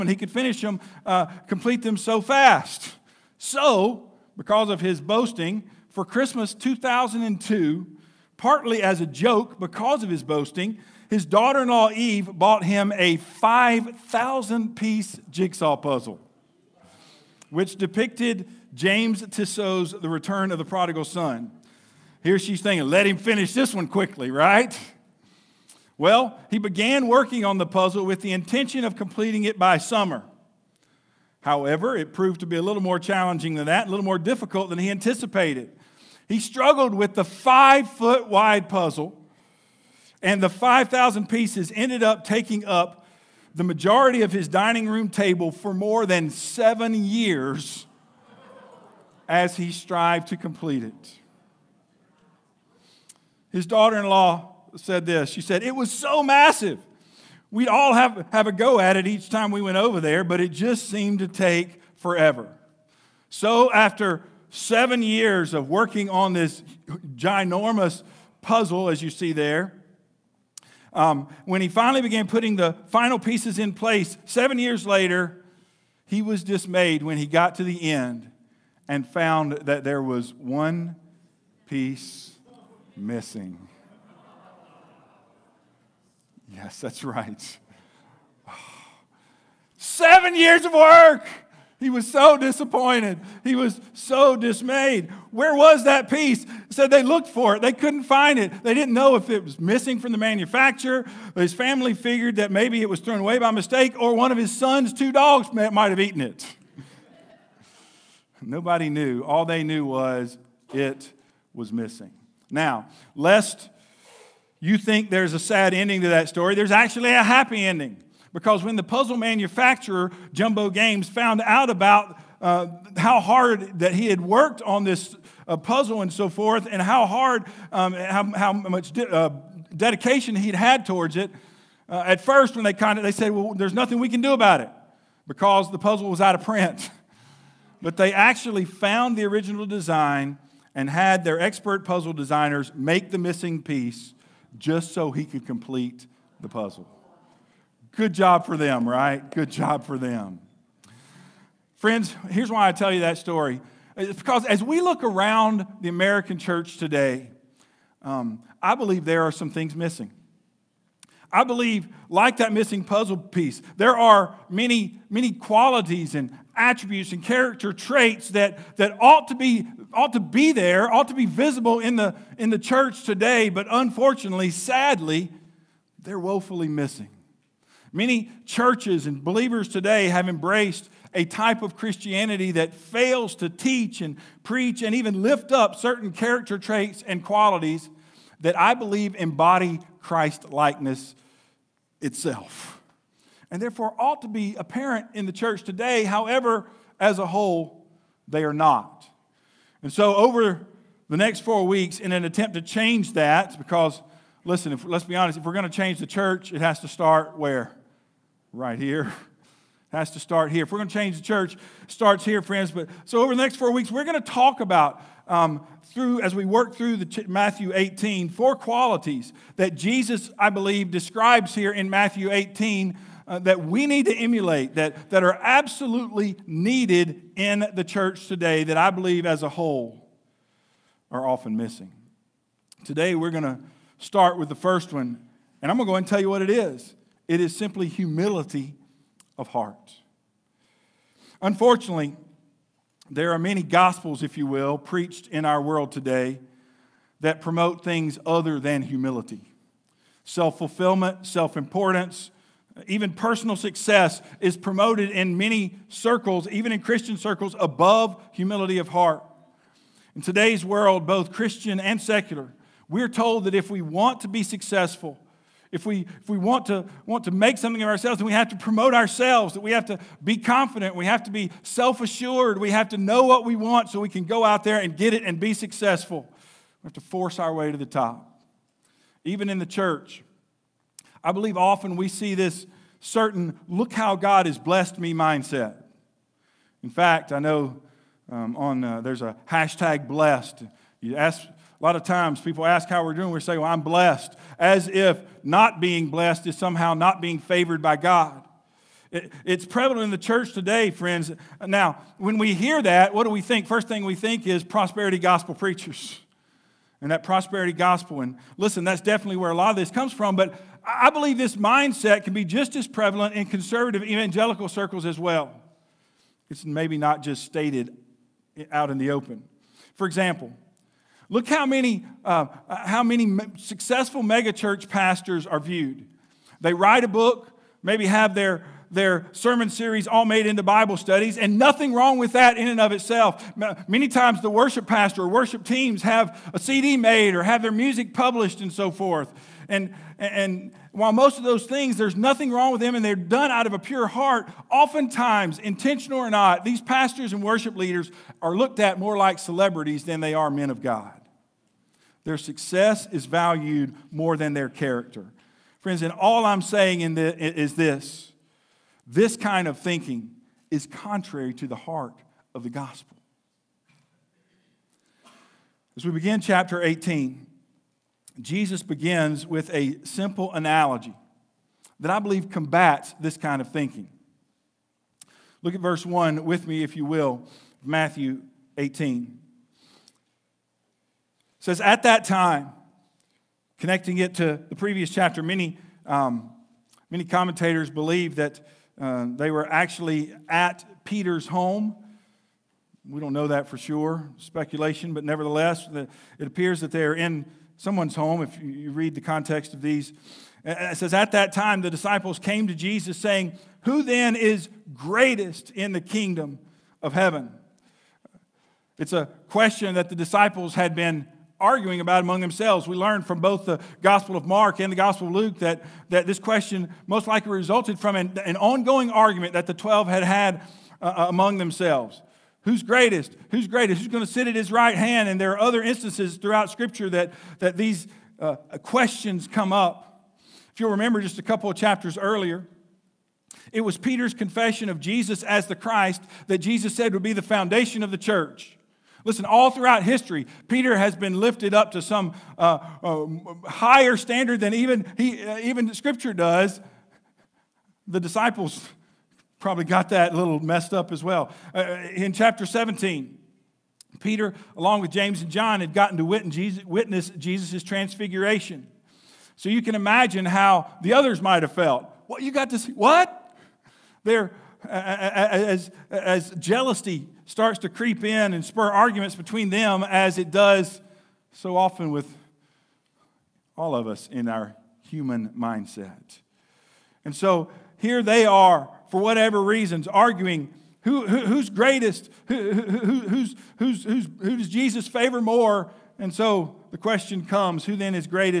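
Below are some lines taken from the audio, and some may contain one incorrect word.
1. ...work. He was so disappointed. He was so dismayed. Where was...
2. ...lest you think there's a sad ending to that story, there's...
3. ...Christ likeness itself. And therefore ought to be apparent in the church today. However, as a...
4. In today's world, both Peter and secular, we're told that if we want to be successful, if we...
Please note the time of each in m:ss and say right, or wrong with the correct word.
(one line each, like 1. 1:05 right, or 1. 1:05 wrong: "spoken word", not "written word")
1. 1:30 right
2. 1:53 right
3. 3:10 right
4. 4:20 wrong: "Christian", not "Peter".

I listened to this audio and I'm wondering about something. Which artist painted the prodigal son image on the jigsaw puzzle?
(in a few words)
James Tissot.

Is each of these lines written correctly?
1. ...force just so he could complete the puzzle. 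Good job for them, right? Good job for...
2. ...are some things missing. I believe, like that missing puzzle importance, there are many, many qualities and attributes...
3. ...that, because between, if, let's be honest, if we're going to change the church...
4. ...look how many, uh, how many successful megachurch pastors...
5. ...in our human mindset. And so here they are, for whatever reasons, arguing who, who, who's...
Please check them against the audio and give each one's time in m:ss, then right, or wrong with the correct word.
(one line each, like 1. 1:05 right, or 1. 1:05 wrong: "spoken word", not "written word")
1. 2:23 wrong: "piece", not "force"
2. 2:39 wrong: "piece", not "importance"
3. 3:23 wrong: "listen", not "between"
4. 5:21 right
5. 7:54 right.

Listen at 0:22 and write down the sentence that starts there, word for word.
Here she's thinking, let him finish this one quickly, right?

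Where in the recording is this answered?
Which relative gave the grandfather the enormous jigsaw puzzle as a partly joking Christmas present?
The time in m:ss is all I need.
0:11.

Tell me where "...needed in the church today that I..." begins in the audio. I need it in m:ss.
3:46.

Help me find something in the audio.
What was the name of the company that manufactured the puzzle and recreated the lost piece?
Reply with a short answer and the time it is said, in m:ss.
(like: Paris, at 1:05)
Jumbo Games, at 2:00.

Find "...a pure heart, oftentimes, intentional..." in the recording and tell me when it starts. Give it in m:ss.
5:43.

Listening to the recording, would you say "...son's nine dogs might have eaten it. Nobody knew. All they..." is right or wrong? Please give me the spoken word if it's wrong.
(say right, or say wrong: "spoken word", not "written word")
wrong: "two", not "nine".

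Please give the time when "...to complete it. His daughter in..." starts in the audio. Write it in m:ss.
0:50.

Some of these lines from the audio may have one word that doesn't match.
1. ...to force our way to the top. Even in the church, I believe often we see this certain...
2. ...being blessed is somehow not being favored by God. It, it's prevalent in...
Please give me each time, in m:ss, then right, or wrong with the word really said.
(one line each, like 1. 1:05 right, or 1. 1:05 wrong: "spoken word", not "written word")
1. 4:36 right
2. 4:55 right.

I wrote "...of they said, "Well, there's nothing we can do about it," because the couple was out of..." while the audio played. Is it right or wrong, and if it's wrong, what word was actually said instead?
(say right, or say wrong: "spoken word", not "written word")
wrong: "puzzle", not "couple".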